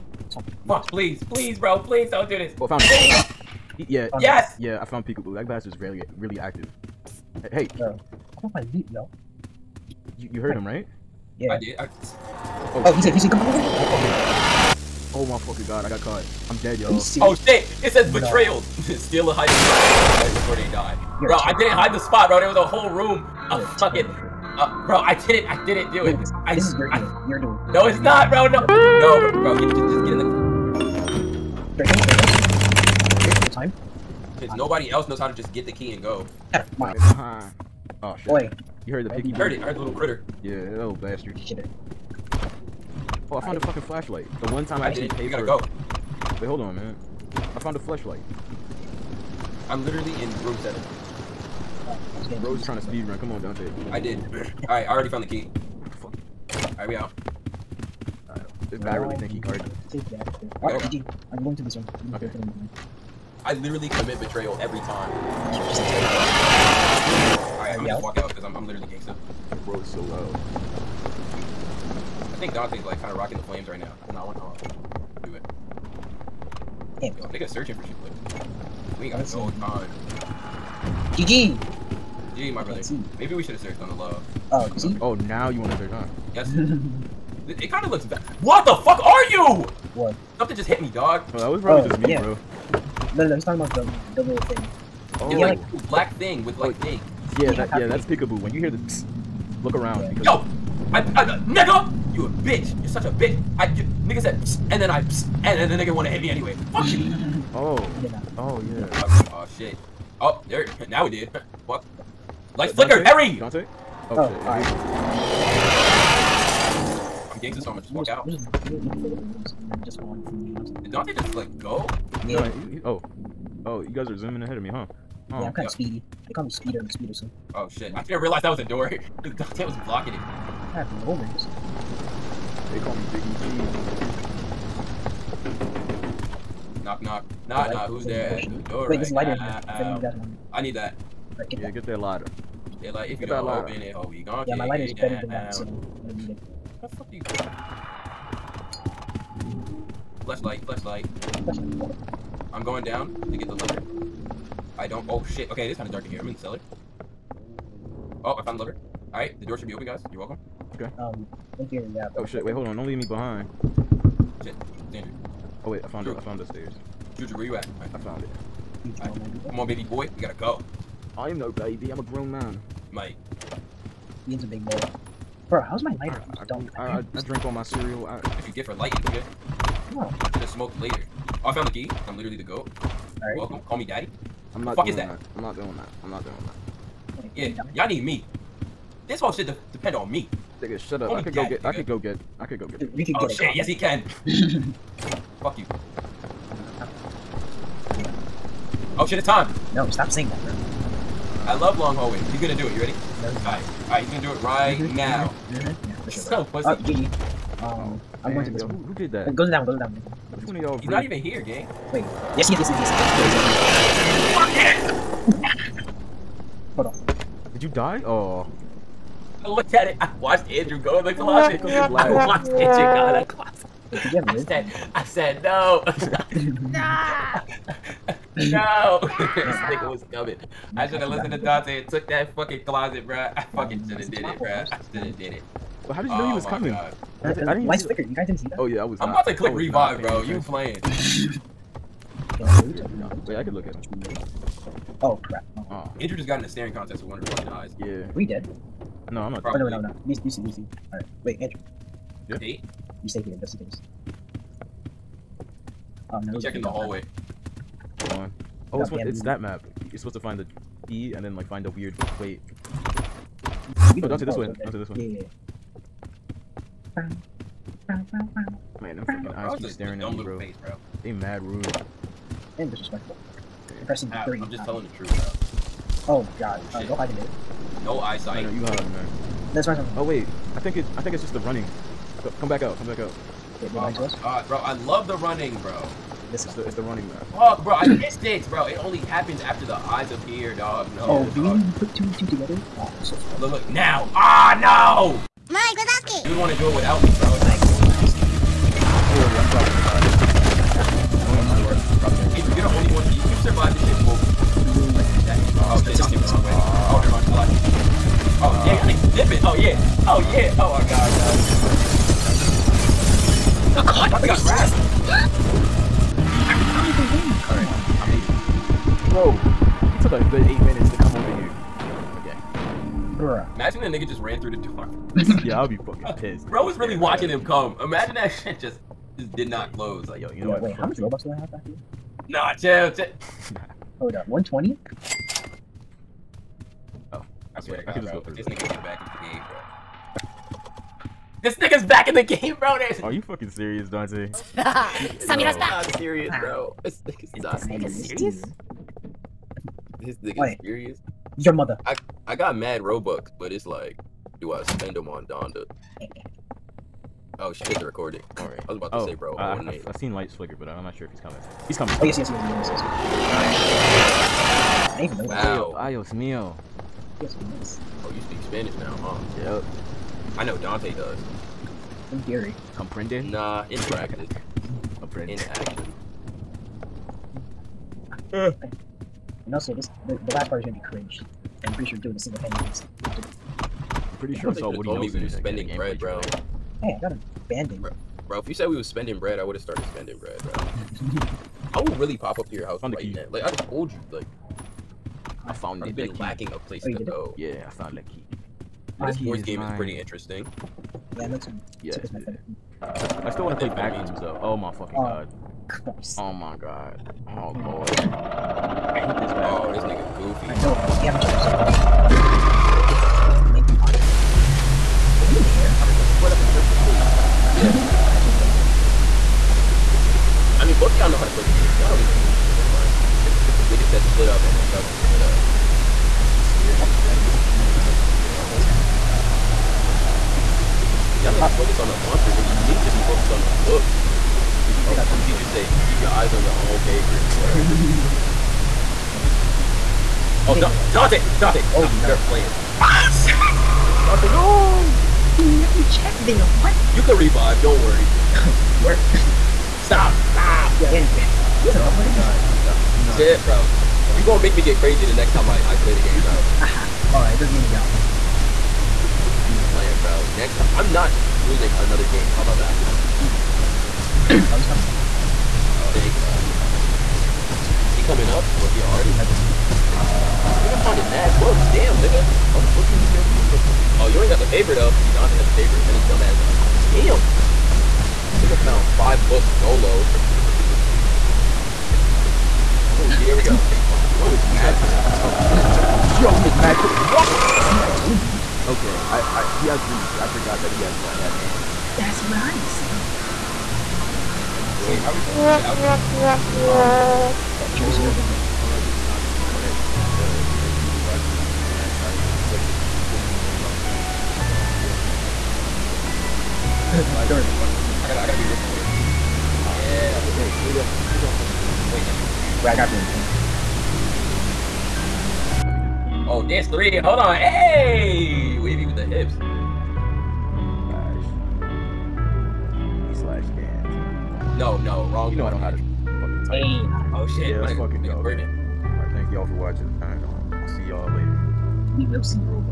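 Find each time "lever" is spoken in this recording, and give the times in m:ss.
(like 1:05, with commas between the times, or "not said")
2:33, 2:38.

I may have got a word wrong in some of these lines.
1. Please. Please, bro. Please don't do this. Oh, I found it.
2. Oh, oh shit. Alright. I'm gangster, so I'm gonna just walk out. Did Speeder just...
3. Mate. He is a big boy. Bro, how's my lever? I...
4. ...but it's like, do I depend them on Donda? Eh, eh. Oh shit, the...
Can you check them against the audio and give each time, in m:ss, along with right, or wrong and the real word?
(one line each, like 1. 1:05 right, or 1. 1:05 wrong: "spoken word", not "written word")
1. 0:00 right
2. 1:54 wrong: "Dante", not "Speeder"
3. 2:52 wrong: "lighter", not "lever"
4. 5:53 wrong: "spend", not "depend".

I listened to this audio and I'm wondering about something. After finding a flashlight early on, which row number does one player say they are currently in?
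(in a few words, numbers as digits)
7.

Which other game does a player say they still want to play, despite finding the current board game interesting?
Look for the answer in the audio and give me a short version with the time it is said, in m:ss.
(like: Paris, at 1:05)
Backrooms, at 6:43.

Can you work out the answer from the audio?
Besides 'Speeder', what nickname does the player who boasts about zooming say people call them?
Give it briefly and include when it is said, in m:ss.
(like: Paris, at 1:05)
Speederson, at 2:06.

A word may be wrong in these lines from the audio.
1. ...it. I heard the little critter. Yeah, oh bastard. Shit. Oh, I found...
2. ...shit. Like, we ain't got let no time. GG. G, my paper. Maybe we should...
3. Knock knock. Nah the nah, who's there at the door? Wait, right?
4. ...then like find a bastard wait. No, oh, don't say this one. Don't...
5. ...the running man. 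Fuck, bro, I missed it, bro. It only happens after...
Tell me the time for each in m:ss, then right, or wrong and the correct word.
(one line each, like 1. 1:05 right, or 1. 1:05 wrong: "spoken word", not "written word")
1. 0:39 right
2. 1:17 wrong: "brother", not "paper"
3. 2:16 right
4. 4:21 wrong: "weird", not "bastard"
5. 4:46 right.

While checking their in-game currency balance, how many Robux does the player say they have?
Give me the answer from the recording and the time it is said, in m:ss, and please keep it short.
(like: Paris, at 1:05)
120, at 5:34.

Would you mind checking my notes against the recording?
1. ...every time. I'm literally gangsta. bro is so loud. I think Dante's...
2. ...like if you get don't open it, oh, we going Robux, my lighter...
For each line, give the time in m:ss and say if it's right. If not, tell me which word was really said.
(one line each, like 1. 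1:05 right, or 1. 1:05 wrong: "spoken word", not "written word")
1. 1:04 right
2. 2:22 wrong: "Yeah", not "Robux".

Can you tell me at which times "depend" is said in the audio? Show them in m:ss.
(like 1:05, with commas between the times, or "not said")
3:09.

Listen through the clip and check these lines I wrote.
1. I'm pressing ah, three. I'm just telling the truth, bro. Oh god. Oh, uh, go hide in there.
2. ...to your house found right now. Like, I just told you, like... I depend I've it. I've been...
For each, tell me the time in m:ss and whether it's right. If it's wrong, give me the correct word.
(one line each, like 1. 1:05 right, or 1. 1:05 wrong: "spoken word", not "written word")
1. 4:33 right
2. 6:32 wrong: "found", not "depend".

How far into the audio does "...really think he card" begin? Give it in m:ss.
0:58.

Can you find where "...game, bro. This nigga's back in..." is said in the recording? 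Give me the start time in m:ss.
5:39.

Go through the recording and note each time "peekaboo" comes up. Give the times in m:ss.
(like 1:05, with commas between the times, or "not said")
0:05, 1:38.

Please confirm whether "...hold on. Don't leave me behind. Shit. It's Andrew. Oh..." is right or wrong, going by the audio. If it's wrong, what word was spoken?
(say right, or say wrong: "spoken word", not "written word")
right.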